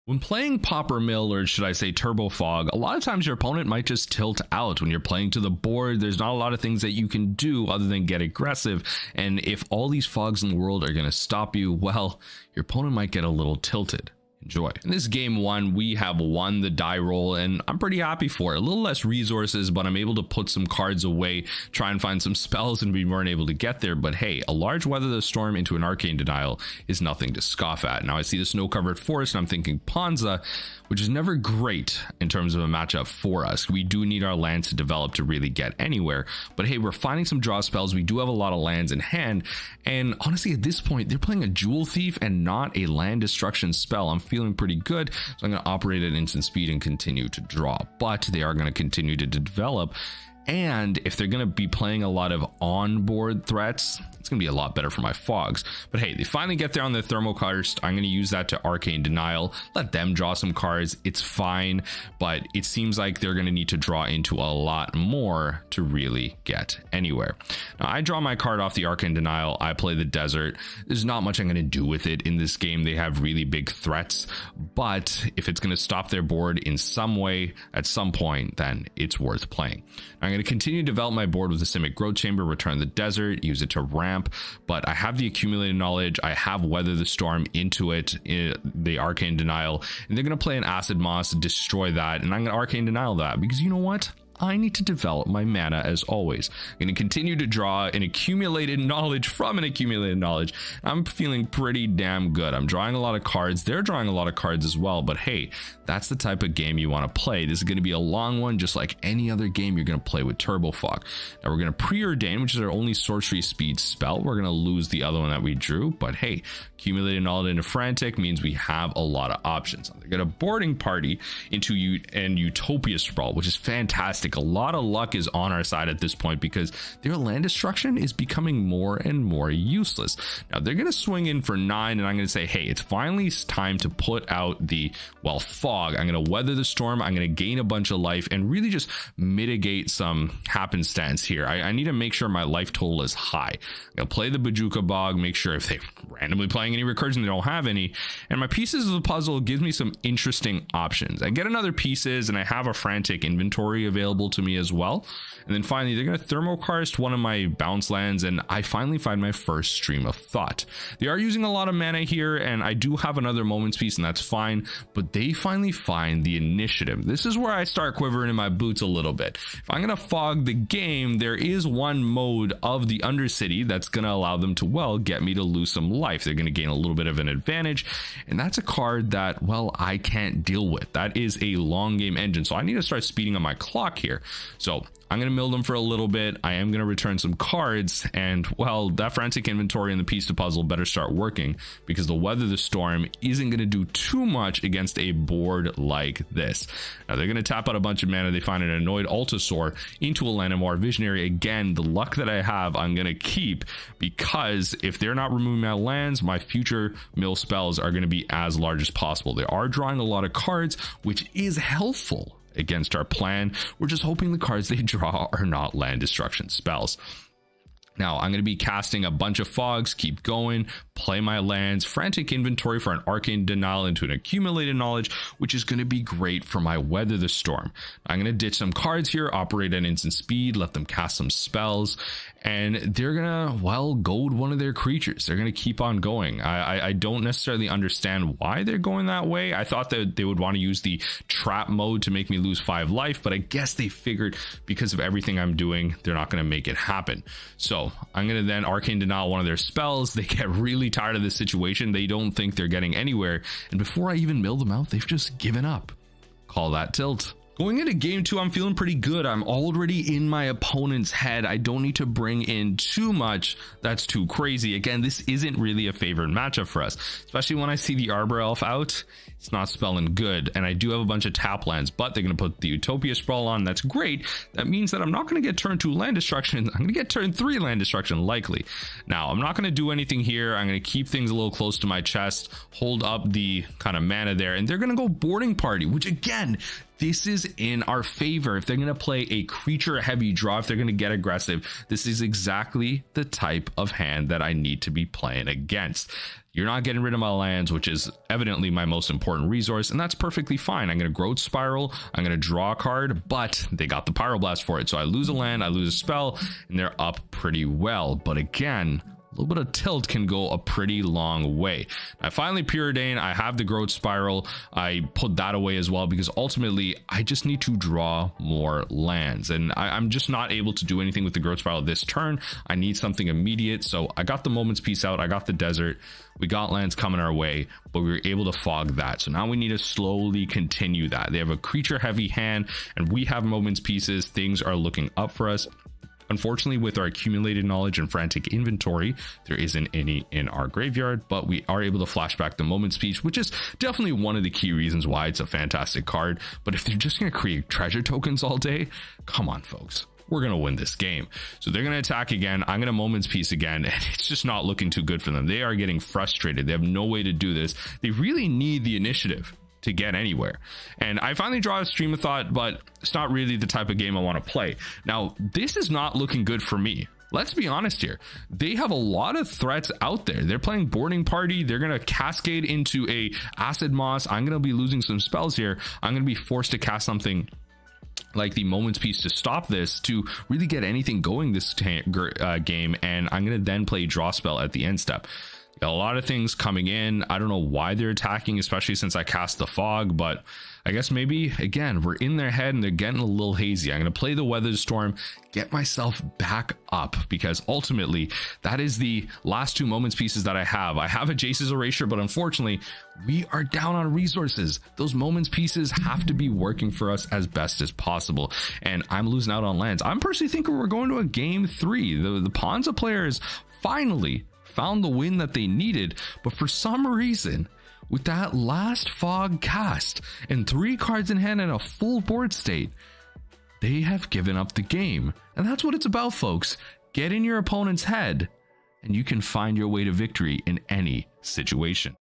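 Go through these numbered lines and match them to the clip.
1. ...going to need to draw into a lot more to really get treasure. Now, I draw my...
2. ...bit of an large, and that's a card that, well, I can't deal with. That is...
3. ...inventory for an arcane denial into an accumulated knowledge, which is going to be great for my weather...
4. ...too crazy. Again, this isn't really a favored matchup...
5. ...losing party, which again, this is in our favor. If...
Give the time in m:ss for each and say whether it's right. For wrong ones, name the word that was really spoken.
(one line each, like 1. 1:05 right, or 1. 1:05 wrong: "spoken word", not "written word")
1. 1:03 wrong: "anywhere", not "treasure"
2. 2:56 wrong: "advantage", not "large"
3. 3:42 right
4. 4:24 right
5. 4:45 wrong: "boarding", not "losing".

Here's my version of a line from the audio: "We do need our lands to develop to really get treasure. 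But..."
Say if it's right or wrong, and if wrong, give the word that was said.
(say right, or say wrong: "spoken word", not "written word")
wrong: "anywhere", not "treasure".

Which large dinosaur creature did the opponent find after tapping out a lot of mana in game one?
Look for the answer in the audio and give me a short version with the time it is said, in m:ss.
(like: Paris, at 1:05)
Annoyed Altisaur, at 3:19.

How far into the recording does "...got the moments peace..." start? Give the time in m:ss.
5:24.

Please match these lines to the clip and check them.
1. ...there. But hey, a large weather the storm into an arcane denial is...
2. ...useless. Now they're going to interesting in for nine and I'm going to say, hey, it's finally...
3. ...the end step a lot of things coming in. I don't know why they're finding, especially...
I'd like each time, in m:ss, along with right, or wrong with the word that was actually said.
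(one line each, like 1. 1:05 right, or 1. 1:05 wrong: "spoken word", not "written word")
1. 0:23 right
2. 2:09 wrong: "swing", not "interesting"
3. 6:24 wrong: "attacking", not "finding".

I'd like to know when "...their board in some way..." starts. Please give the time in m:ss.
1:16.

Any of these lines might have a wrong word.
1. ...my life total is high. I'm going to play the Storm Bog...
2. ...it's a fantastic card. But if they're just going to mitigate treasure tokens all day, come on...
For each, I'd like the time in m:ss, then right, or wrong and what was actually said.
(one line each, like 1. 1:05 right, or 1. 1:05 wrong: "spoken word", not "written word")
1. 2:22 wrong: "Bojuka", not "Storm"
2. 5:45 wrong: "create", not "mitigate".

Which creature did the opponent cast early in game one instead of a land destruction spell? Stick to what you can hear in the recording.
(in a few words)
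Jewel Thief.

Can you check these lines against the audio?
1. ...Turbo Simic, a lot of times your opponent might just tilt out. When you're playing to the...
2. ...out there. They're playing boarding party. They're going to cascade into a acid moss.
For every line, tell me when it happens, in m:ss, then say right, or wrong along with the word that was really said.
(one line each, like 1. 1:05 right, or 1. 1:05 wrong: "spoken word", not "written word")
1. 0:01 wrong: "Fog", not "Simic"
2. 6:10 right.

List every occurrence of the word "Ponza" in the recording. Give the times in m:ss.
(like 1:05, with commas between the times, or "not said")
0:29, 6:52.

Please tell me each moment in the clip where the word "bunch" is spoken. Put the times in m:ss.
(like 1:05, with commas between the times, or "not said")
2:17, 3:17, 3:39, 4:31.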